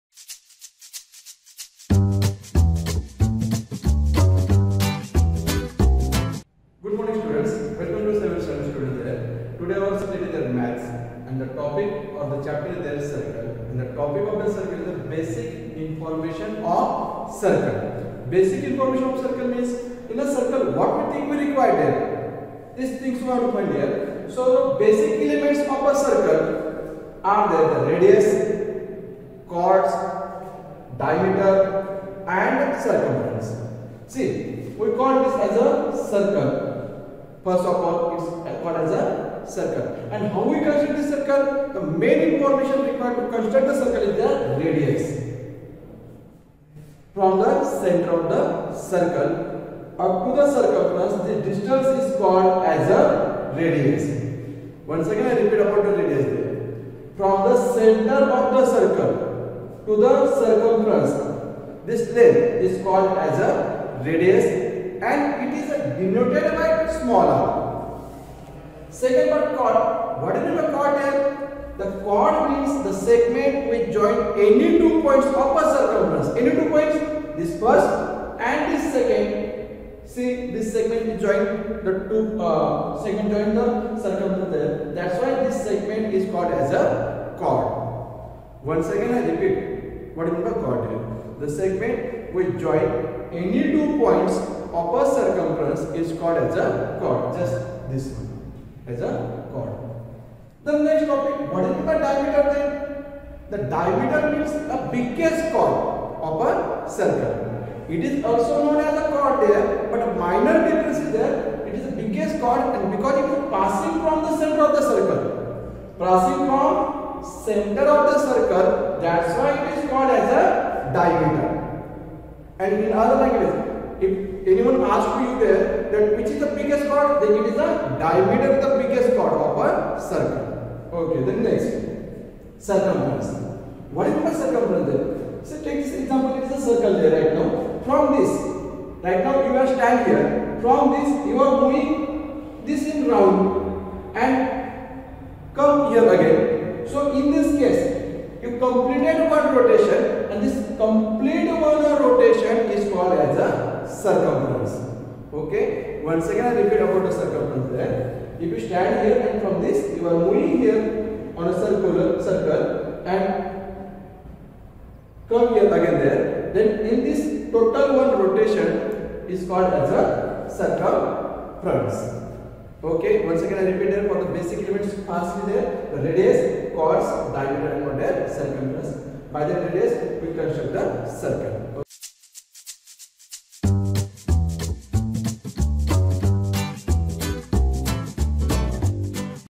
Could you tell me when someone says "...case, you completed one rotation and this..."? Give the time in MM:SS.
02:27.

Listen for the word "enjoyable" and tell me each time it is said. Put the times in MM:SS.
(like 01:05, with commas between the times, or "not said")
not said.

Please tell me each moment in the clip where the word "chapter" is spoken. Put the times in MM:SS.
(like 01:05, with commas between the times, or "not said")
00:12.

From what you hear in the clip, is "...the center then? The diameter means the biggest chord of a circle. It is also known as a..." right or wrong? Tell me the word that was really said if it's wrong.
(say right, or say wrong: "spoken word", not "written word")
wrong: "diameter", not "center".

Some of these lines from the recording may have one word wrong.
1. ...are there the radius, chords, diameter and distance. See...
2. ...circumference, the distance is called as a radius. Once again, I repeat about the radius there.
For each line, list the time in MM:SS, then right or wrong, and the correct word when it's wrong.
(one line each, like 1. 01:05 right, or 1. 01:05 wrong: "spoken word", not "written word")
1. 00:27 wrong: "circumference", not "distance"
2. 00:50 right.